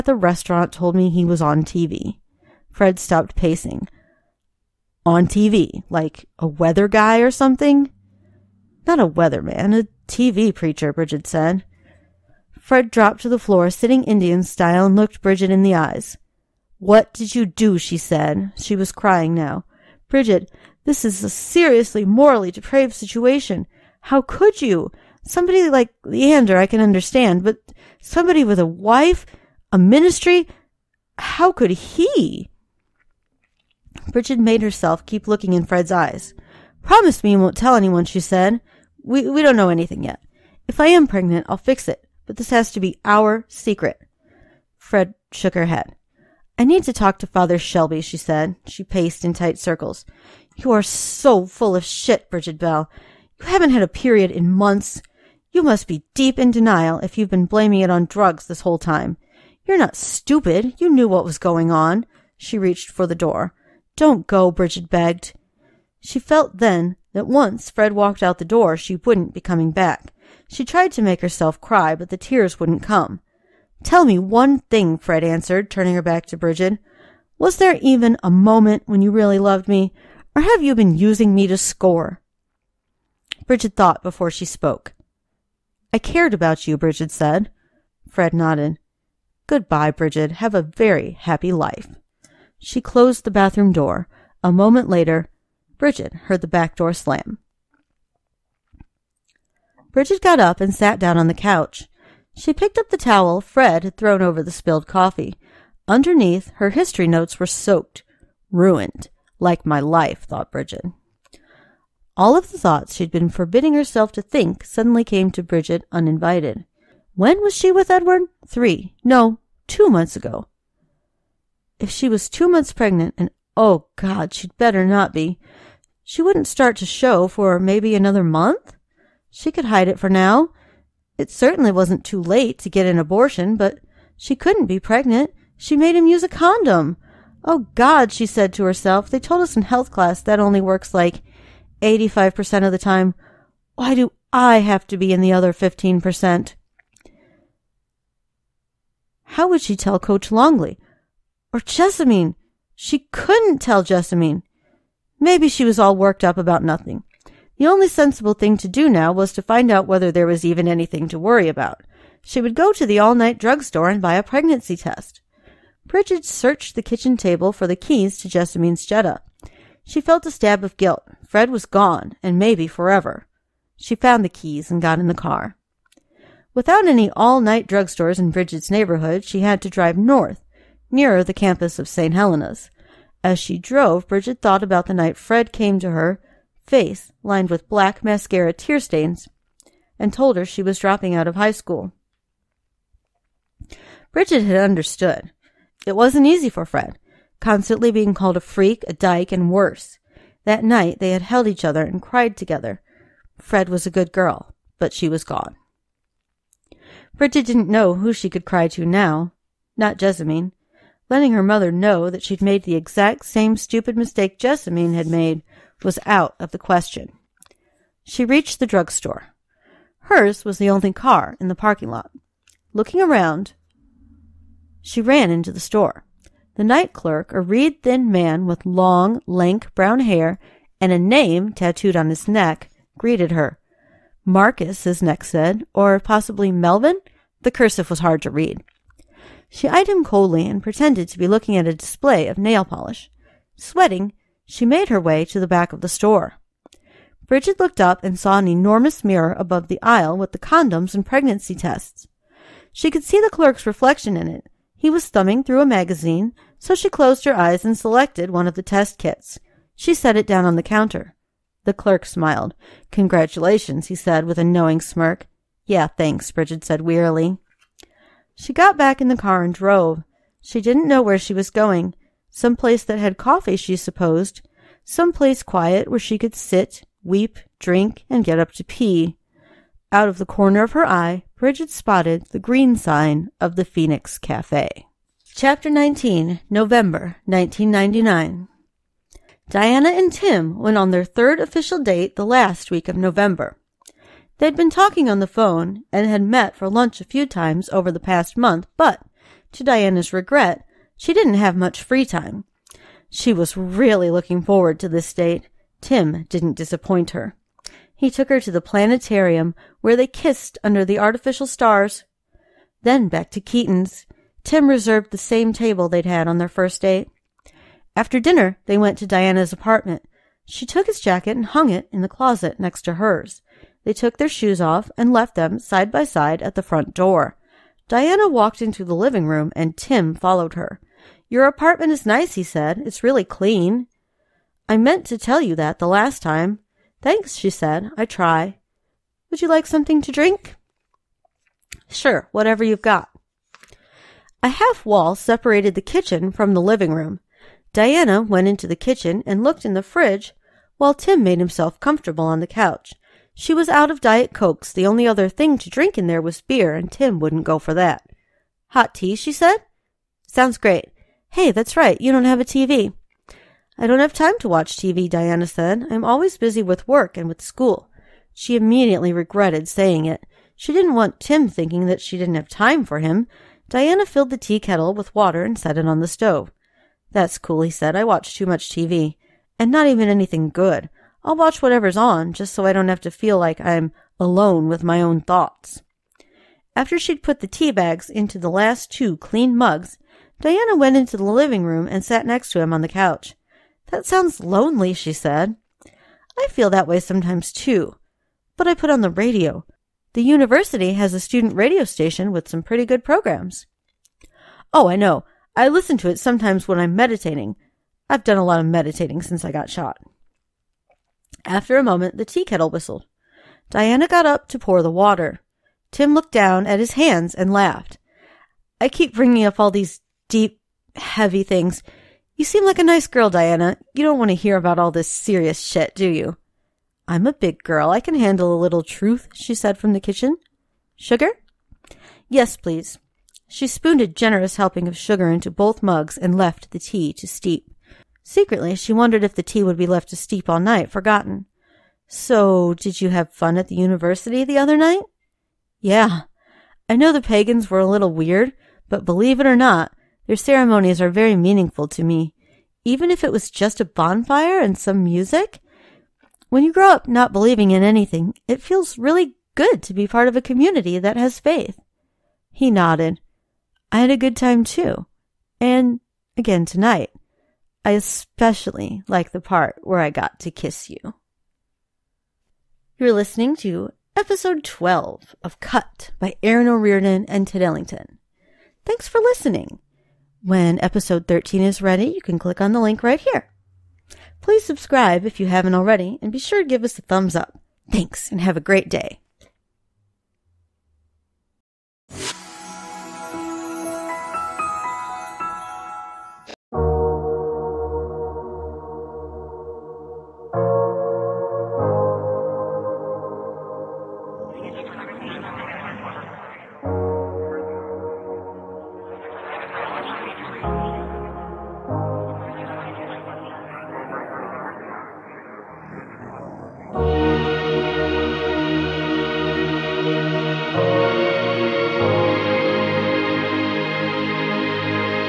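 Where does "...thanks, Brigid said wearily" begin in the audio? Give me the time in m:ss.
4:25.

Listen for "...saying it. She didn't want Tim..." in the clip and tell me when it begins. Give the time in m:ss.
6:09.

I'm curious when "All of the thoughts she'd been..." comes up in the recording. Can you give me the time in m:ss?
1:52.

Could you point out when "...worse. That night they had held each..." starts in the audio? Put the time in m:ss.
3:19.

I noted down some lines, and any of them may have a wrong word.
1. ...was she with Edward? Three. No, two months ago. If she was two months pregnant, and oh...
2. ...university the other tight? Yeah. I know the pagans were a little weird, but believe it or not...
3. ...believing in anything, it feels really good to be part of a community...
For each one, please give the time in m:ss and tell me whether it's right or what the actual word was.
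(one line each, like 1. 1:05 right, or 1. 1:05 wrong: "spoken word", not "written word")
1. 1:57 right
2. 7:23 wrong: "night", not "tight"
3. 7:37 right.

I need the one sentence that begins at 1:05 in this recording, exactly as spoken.
She felt then that once Fred walked out the door, she wouldn't be coming back.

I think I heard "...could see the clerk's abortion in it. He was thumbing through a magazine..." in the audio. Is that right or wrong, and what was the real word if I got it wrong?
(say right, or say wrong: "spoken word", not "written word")
wrong: "reflection", not "abortion".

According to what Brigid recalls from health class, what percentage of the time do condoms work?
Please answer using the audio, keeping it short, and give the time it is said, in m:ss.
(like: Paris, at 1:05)
85%, at 2:21.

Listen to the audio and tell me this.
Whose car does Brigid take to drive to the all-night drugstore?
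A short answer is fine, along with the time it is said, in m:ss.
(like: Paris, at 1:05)
Jessamine's Jetta, at 2:48.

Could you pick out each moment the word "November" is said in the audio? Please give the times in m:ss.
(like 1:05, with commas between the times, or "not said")
4:46, 4:52.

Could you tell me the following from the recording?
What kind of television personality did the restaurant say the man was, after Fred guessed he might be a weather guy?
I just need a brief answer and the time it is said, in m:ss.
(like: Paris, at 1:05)
TV preacher, at 0:09.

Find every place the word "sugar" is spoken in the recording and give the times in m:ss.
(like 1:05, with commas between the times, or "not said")
7:10, 7:14.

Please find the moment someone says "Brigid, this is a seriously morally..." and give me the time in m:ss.
0:20.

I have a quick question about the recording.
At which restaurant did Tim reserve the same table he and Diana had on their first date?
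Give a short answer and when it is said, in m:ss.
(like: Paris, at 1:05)
Keaton's, at 5:13.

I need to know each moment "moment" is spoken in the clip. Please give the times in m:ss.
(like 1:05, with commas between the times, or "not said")
1:18, 1:34, 6:51.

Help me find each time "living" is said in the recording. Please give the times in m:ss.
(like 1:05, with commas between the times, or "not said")
5:28, 5:46, 6:31.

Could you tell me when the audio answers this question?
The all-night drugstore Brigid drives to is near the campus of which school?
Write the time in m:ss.
3:01.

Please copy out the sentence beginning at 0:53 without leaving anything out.
You haven't had a period in months.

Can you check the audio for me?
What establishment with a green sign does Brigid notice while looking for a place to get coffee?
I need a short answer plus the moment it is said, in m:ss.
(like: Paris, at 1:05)
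Phoenix Cafe, at 4:43.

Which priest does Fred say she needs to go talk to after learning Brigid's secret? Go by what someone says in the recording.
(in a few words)
Father Shelby.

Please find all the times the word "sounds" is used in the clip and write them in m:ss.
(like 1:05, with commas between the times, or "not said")
6:00, 6:34.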